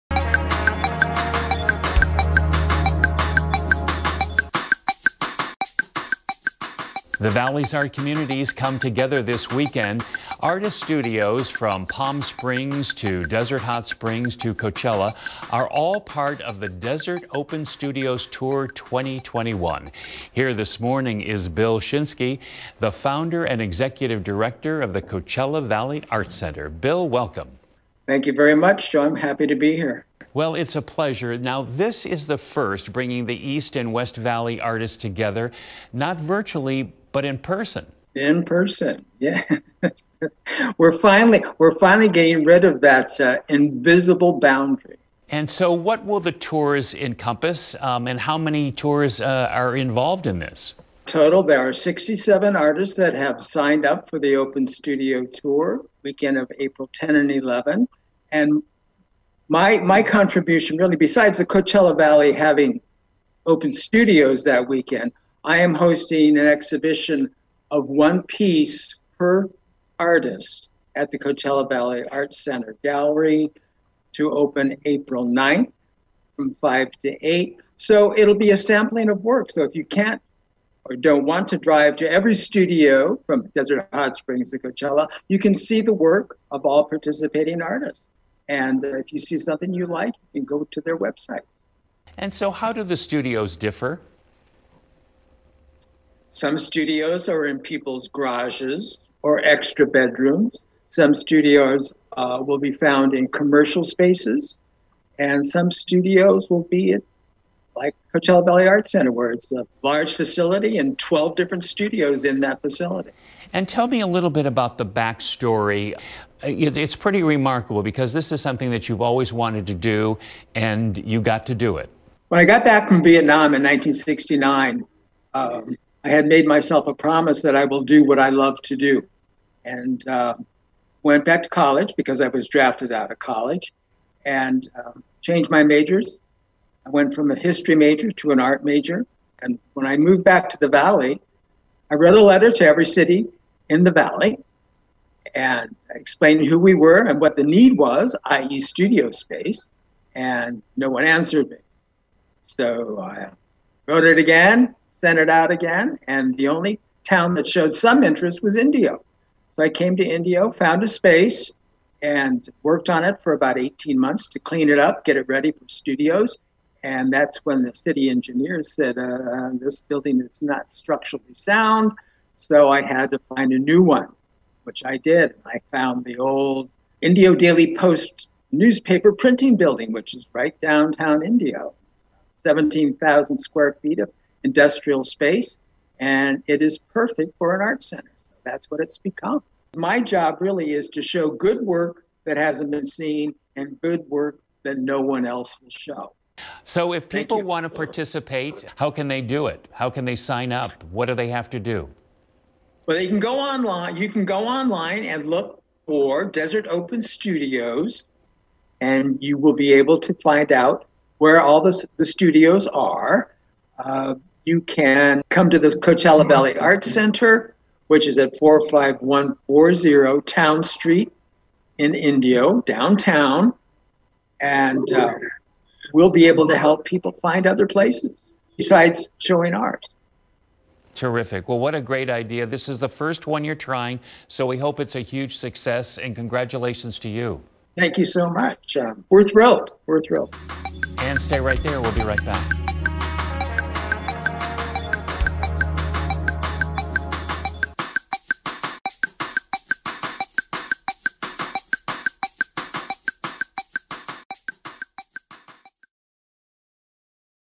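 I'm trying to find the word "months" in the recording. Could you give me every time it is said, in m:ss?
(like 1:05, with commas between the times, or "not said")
2:43.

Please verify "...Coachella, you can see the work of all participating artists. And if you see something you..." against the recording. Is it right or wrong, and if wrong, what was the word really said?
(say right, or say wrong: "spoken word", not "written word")
right.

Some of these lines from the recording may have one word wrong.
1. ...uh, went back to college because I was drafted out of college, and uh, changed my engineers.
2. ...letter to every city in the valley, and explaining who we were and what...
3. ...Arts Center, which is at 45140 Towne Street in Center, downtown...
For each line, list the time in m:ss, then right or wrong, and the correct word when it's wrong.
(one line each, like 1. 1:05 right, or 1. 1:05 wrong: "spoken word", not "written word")
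1. 2:10 wrong: "majors", not "engineers"
2. 2:22 right
3. 3:36 wrong: "Indio", not "Center".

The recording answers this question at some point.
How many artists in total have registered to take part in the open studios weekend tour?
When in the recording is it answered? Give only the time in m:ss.
0:51.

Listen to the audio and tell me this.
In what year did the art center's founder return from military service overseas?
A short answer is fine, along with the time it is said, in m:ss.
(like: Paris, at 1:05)
1969, at 2:03.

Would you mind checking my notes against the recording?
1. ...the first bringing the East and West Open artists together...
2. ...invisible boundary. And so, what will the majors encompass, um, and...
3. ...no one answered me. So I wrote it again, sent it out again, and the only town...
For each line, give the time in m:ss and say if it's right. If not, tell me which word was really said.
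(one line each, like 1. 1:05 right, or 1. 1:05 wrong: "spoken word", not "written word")
1. 0:32 wrong: "Valley", not "Open"
2. 0:43 wrong: "tours", not "majors"
3. 2:30 right.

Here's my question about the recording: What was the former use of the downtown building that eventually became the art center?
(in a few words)
Newspaper printing building.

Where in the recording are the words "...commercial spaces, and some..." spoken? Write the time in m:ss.
1:43.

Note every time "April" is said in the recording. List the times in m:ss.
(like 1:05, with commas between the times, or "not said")
0:56, 1:14.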